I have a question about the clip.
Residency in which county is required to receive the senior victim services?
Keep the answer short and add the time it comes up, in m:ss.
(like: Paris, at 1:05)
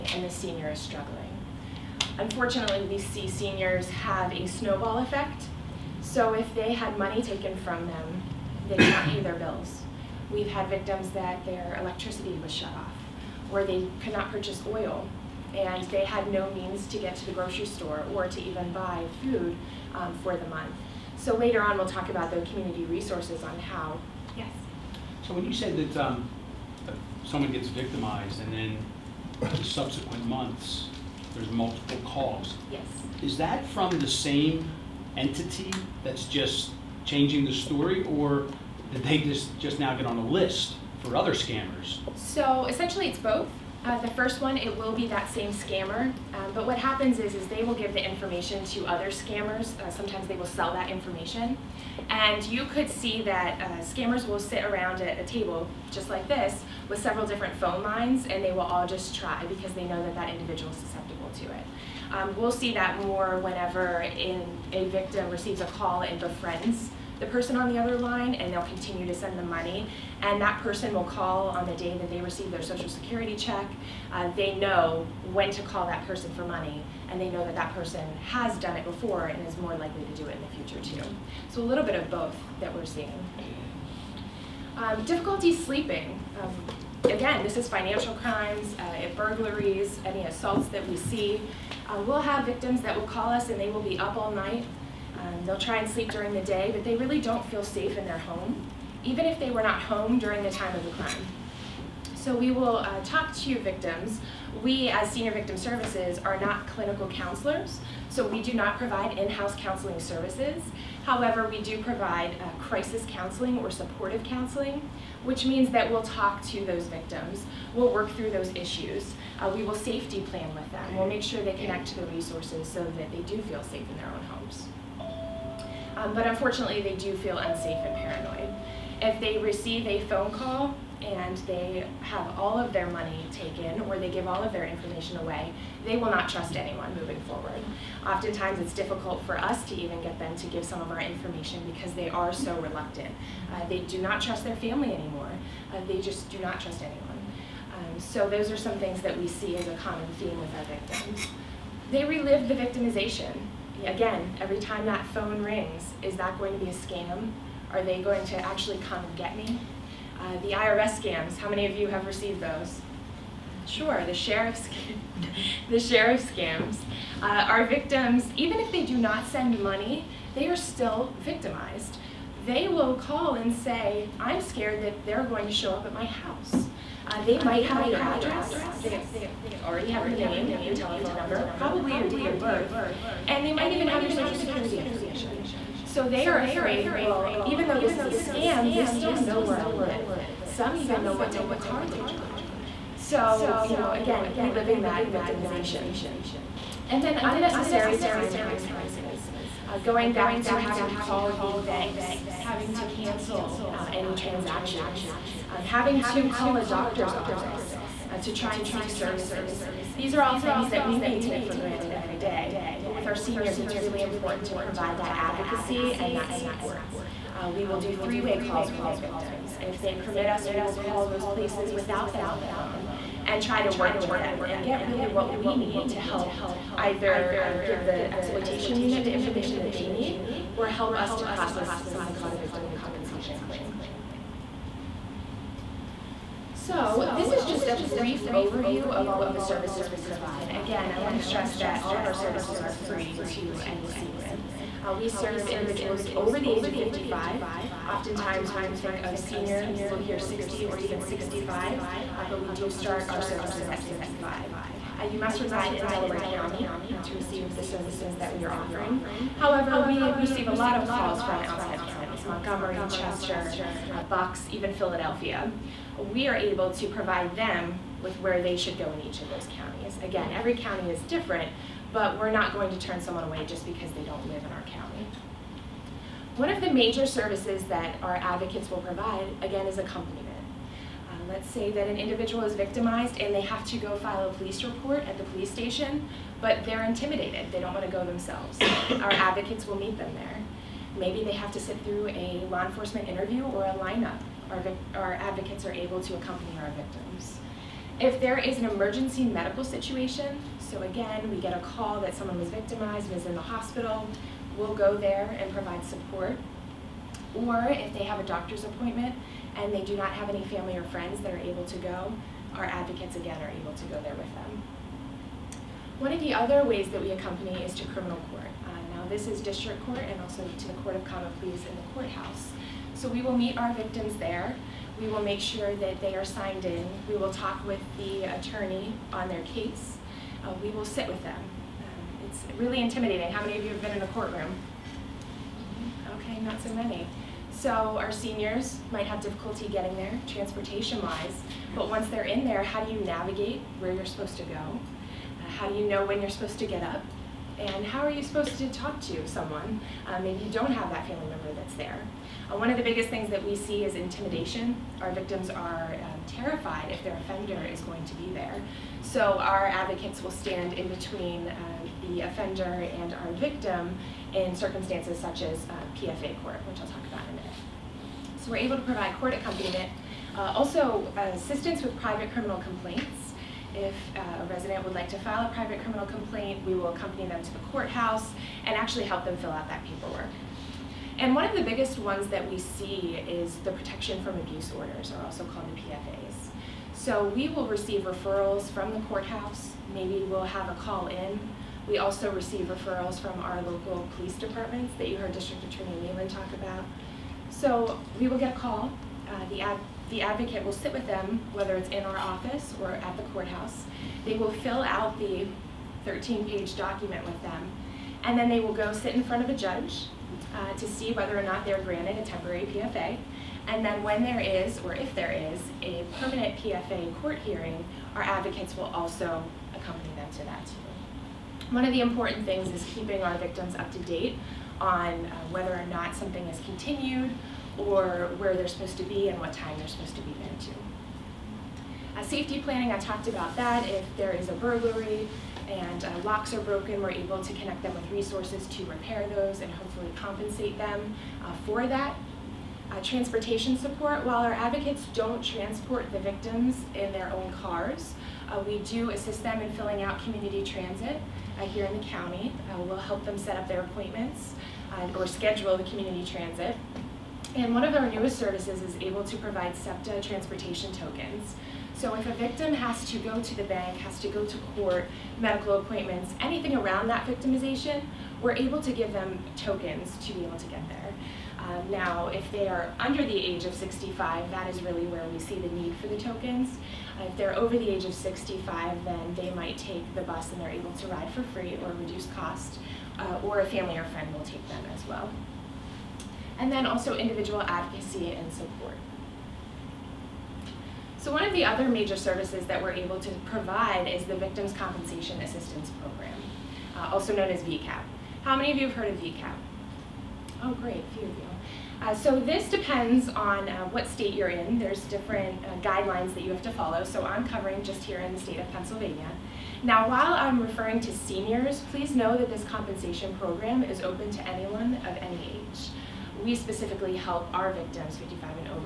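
Delaware County, at 4:15.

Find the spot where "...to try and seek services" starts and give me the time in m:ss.
3:28.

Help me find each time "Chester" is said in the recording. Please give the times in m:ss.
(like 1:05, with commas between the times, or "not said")
4:22.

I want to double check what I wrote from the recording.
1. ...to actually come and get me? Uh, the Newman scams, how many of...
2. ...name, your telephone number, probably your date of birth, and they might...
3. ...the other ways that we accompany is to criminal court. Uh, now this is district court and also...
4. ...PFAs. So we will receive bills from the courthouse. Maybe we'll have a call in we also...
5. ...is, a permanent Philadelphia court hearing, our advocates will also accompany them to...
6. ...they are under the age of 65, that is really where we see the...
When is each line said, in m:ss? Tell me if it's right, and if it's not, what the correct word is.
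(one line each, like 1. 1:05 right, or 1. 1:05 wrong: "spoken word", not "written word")
1. 2:38 wrong: "IRS", not "Newman"
2. 3:00 right
3. 5:16 right
4. 6:25 wrong: "referrals", not "bills"
5. 6:55 wrong: "PFA", not "Philadelphia"
6. 7:52 right.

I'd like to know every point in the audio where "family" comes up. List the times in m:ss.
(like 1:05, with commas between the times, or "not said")
2:24, 5:10, 5:51, 8:03.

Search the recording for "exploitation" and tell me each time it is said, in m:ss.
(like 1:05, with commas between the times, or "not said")
3:48.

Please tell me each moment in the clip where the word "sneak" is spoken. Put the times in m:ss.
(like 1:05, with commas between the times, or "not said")
not said.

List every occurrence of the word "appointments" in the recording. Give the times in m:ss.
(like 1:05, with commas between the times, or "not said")
5:08, 7:33, 7:45.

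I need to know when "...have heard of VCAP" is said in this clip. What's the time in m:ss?
8:18.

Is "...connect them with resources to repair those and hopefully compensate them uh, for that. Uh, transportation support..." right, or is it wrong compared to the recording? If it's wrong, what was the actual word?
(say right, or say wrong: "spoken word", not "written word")
right.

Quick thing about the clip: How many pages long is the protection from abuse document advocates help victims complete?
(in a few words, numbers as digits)
13.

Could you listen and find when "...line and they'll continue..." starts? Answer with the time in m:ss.
1:07.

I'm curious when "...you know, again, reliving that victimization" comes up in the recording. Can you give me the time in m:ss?
3:13.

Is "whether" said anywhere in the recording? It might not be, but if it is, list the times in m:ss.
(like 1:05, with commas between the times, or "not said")
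6:41, 6:51, 7:05.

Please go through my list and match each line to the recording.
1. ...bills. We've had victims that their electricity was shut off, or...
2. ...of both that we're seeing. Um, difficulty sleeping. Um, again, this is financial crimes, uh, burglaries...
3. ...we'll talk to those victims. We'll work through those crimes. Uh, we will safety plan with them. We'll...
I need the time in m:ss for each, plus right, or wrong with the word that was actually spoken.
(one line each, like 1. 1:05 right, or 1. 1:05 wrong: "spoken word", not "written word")
1. 0:09 right
2. 1:21 right
3. 1:55 wrong: "issues", not "crimes".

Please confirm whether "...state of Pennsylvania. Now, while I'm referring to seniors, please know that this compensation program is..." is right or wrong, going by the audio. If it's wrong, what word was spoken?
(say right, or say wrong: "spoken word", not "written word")
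right.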